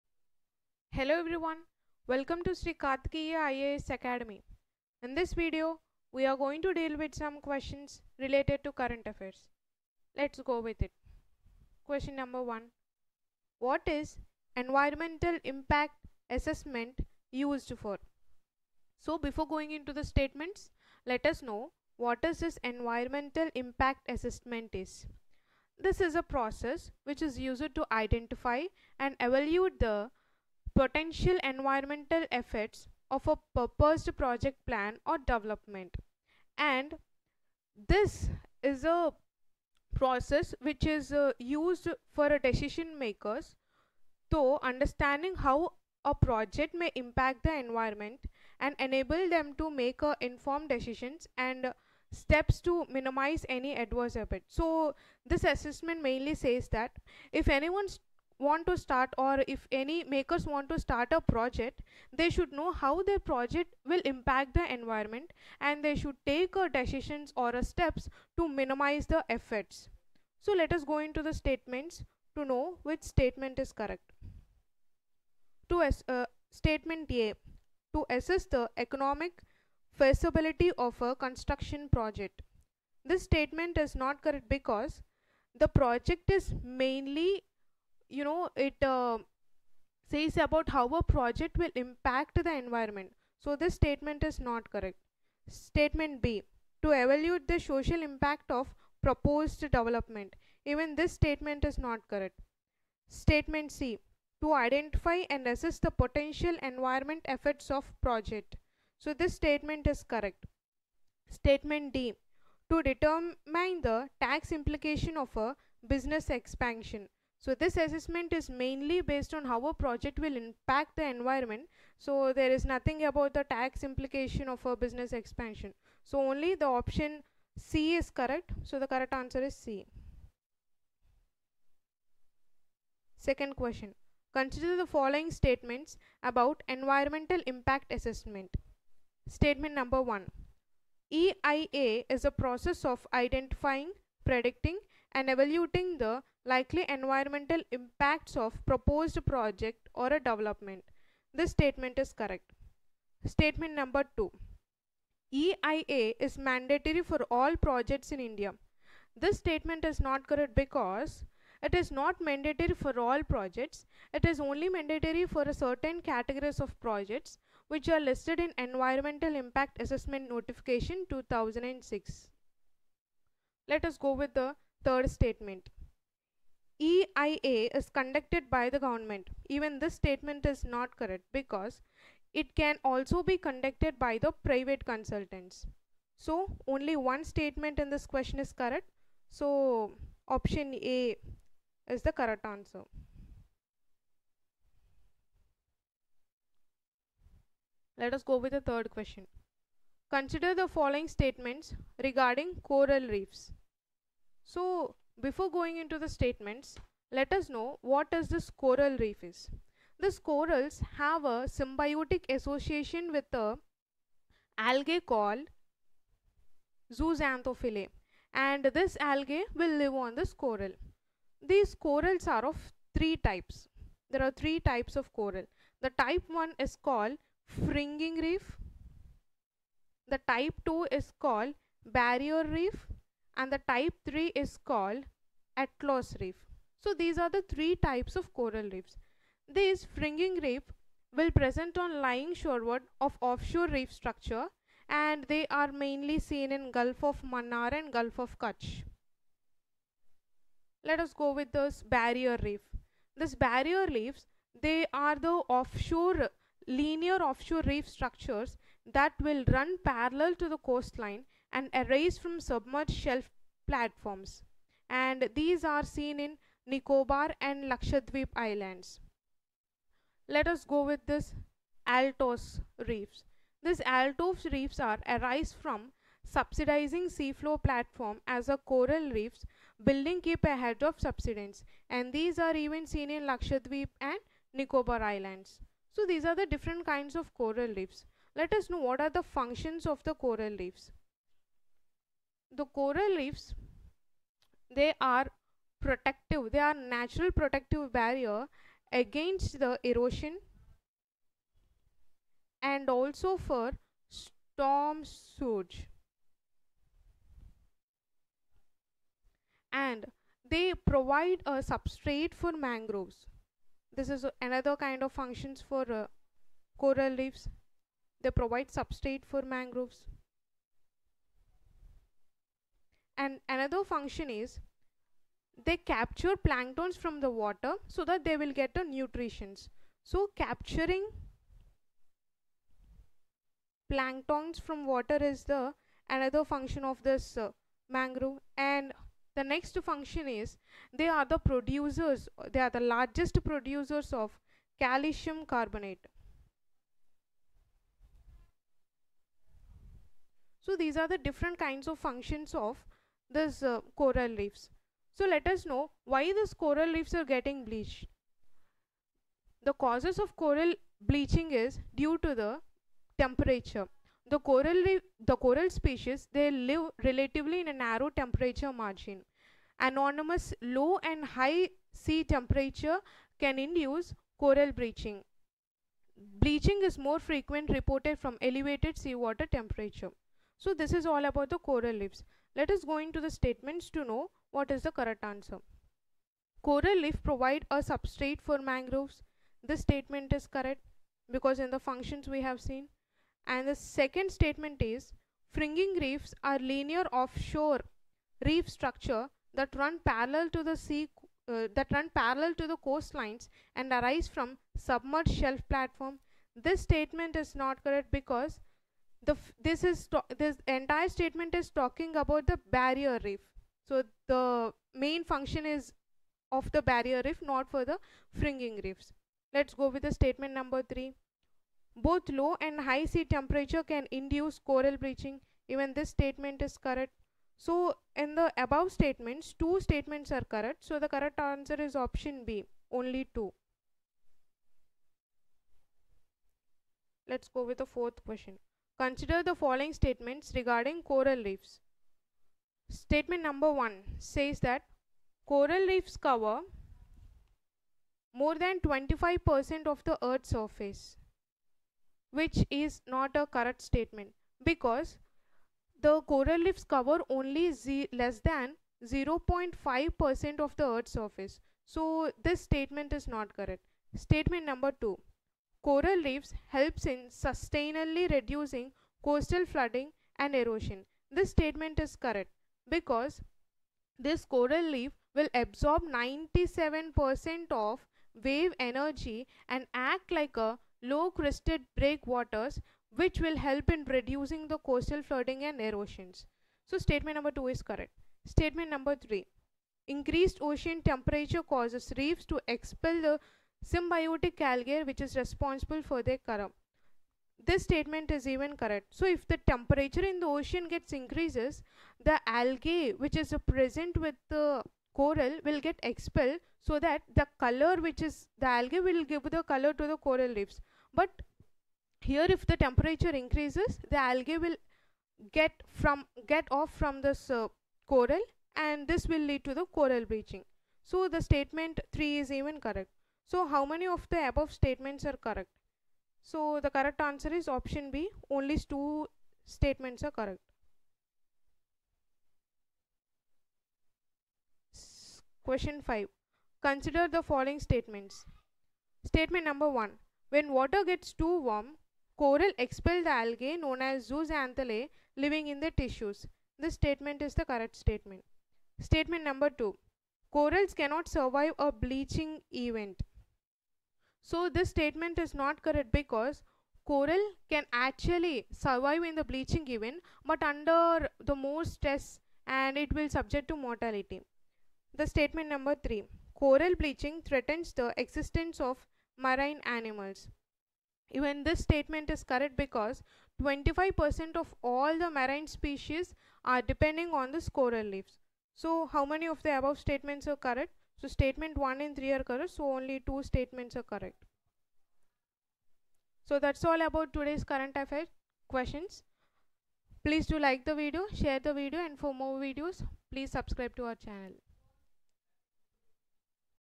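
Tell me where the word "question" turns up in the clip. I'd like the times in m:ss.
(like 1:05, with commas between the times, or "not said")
0:07, 0:11, 2:13, 3:08, 3:18, 7:18, 8:55, 9:48.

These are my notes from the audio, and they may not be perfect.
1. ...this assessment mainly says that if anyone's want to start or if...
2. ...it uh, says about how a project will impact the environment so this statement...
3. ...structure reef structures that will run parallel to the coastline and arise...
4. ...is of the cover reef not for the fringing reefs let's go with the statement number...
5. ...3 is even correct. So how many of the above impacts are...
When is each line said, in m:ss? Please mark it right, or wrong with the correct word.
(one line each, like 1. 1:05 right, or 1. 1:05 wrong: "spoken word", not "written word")
1. 0:55 right
2. 1:28 right
3. 4:17 wrong: "offshore", not "structure"
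4. 6:55 wrong: "barrier", not "cover"
5. 8:42 wrong: "statements", not "impacts".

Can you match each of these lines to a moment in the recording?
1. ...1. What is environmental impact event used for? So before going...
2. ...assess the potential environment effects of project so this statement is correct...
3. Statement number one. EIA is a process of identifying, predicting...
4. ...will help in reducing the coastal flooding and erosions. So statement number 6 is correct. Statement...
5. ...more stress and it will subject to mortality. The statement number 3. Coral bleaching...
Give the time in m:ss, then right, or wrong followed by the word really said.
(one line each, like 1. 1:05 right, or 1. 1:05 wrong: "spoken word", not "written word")
1. 0:12 wrong: "assessment", not "event"
2. 1:45 right
3. 2:19 right
4. 8:03 wrong: "2", not "6"
5. 9:21 right.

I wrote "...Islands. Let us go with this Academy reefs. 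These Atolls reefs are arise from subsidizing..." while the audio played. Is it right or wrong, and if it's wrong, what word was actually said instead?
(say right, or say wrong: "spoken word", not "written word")
wrong: "Atolls", not "Academy".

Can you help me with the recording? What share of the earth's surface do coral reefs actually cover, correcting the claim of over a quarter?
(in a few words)
Less than 0.5%.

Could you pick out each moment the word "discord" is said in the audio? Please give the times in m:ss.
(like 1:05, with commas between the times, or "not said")
not said.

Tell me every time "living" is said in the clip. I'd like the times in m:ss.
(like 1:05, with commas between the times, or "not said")
9:05.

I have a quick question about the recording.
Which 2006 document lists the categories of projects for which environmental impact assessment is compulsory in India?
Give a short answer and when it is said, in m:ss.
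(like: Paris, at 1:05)
Environmental Impact Assessment Notification 2006, at 2:48.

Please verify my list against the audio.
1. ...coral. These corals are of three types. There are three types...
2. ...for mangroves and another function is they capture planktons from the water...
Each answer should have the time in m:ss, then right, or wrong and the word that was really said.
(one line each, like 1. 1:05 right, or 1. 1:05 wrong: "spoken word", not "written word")
1. 3:40 right
2. 5:19 right.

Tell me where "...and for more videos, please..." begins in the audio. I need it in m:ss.
9:52.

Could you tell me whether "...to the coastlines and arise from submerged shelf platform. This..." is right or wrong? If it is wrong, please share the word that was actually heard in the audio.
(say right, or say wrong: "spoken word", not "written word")
right.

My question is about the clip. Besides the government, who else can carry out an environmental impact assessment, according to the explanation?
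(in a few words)
Private consultants.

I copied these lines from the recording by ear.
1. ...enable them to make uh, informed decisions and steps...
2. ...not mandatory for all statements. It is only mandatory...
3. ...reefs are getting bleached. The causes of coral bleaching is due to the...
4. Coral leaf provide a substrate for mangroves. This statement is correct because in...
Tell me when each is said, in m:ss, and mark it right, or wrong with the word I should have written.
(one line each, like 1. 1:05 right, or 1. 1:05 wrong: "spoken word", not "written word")
1. 0:48 right
2. 2:41 wrong: "projects", not "statements"
3. 5:56 right
4. 6:26 right.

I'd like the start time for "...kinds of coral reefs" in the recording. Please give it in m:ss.
4:46.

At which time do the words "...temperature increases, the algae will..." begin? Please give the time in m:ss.
8:32.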